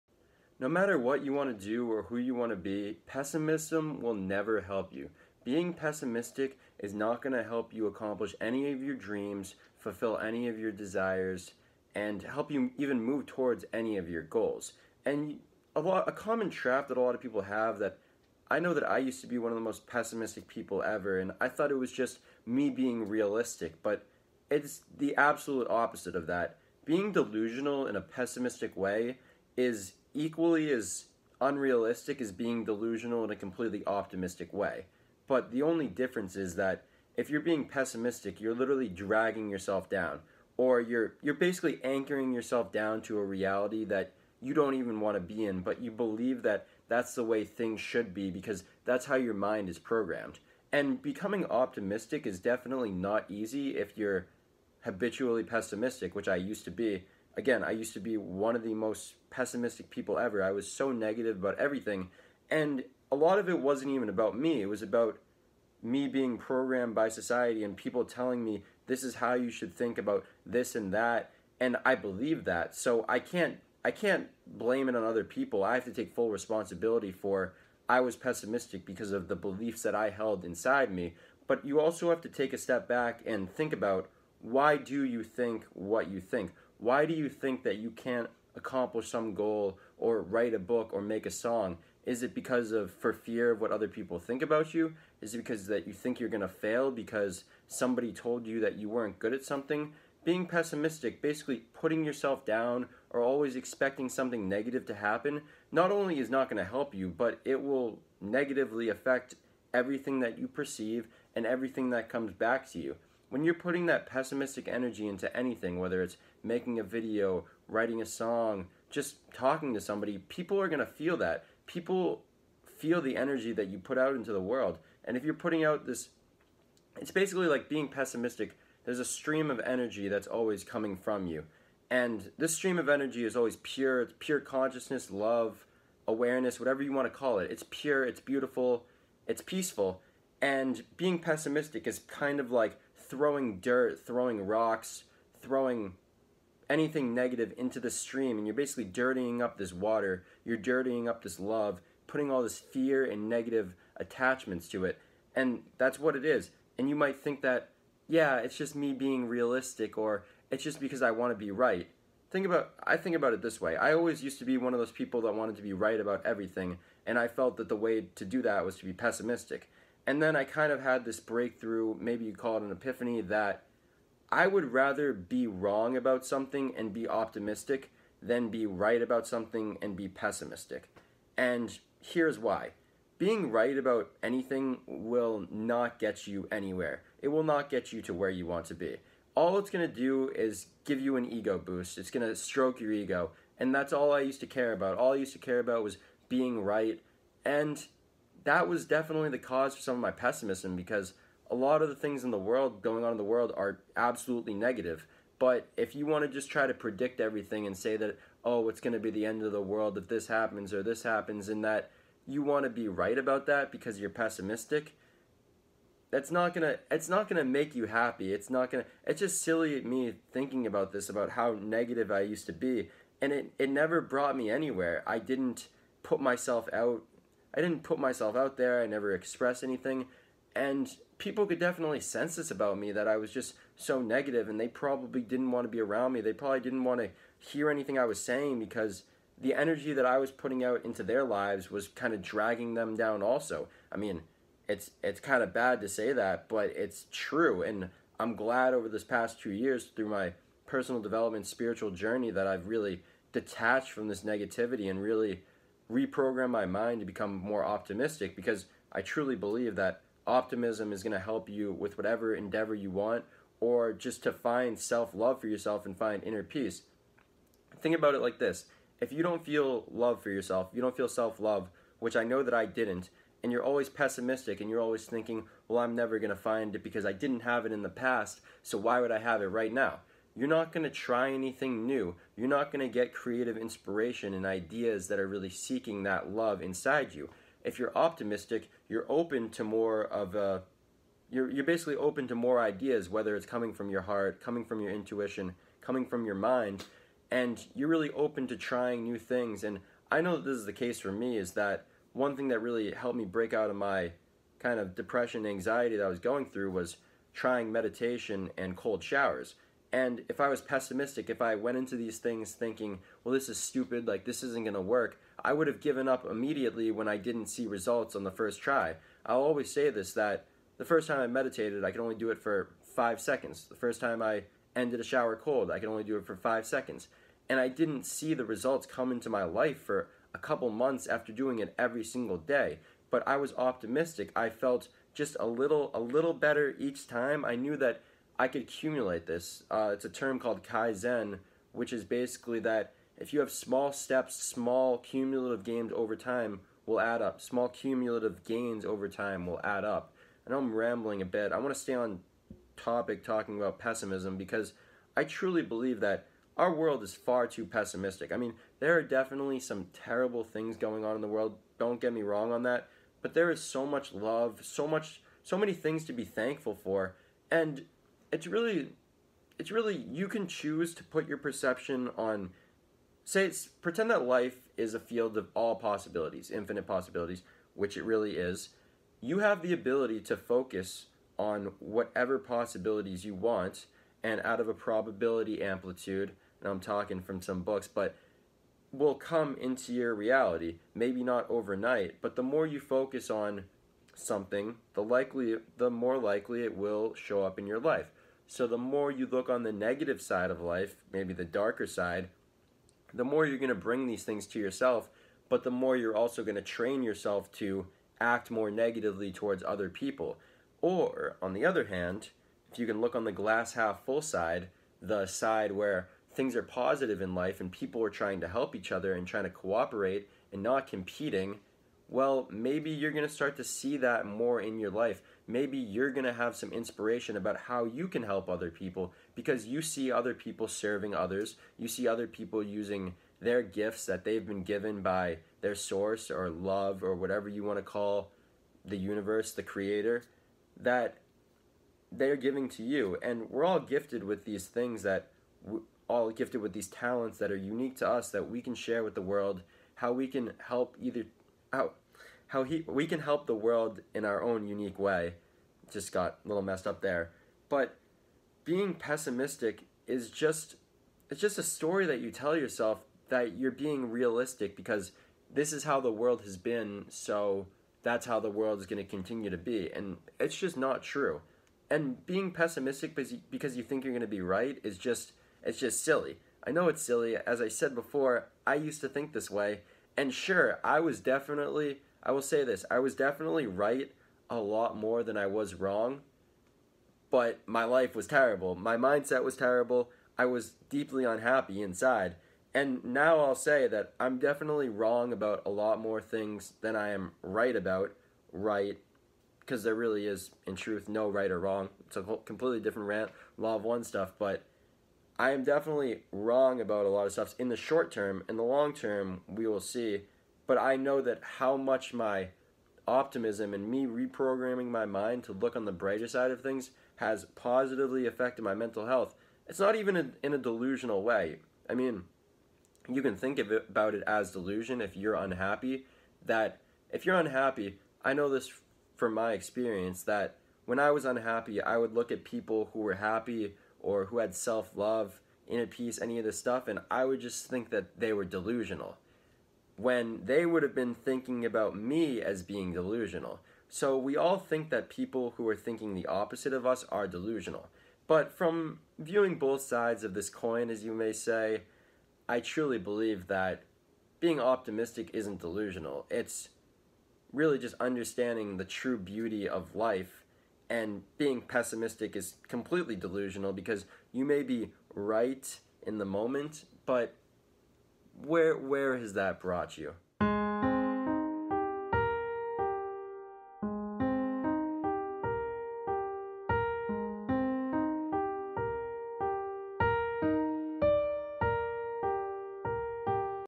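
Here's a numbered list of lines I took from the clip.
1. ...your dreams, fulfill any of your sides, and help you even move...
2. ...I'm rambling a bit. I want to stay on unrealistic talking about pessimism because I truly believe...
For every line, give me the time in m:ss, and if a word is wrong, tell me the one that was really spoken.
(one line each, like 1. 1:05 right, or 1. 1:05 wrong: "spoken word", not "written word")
1. 0:08 wrong: "desires", not "sides"
2. 5:50 wrong: "topic", not "unrealistic".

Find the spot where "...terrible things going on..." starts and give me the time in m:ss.
5:59.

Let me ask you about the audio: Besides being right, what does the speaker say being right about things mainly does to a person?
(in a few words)
stroke your ego.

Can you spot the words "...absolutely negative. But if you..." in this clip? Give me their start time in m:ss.
3:23.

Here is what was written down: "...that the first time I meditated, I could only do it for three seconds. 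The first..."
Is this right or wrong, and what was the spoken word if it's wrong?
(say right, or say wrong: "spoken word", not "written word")
wrong: "five", not "three".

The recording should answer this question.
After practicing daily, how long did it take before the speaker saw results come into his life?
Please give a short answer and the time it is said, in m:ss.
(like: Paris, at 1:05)
a couple months, at 5:30.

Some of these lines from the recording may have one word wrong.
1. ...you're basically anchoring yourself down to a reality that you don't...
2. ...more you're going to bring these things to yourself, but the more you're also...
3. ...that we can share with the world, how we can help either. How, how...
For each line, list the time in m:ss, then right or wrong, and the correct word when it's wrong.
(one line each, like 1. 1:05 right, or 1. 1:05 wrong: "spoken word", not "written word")
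1. 0:41 right
2. 6:43 right
3. 7:28 right.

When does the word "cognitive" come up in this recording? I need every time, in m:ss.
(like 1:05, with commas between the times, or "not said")
not said.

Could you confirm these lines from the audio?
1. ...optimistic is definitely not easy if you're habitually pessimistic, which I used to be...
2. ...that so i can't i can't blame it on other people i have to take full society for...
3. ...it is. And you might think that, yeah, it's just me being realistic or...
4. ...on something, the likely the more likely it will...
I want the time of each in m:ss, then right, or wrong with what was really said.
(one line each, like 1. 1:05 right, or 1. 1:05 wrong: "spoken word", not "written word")
1. 0:51 right
2. 1:12 wrong: "responsibility", not "society"
3. 2:36 right
4. 6:33 right.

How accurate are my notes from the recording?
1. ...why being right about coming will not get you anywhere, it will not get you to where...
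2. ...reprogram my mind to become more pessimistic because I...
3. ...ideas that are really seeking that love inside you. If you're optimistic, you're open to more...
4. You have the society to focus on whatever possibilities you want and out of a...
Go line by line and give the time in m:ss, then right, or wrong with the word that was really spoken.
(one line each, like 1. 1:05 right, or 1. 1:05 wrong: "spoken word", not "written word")
1. 3:02 wrong: "anything", not "coming"
2. 4:15 wrong: "optimistic", not "pessimistic"
3. 4:44 right
4. 6:19 wrong: "ability", not "society".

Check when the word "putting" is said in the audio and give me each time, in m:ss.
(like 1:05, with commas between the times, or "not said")
1:41, 1:53, 2:05, 2:32, 4:00.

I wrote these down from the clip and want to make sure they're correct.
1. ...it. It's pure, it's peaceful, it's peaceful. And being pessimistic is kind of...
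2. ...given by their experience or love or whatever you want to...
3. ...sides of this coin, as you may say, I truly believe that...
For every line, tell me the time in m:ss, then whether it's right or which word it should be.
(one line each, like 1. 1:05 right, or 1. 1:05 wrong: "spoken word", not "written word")
1. 2:17 wrong: "beautiful", not "peaceful"
2. 7:14 wrong: "source", not "experience"
3. 9:09 right.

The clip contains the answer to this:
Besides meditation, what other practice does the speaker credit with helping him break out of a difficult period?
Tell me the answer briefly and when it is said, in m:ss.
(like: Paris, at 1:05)
cold showers, at 5:08.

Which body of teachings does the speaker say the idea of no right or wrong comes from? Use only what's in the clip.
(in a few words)
law of one.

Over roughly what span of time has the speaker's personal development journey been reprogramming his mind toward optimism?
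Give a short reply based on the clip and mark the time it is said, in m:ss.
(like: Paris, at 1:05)
2 years, at 4:09.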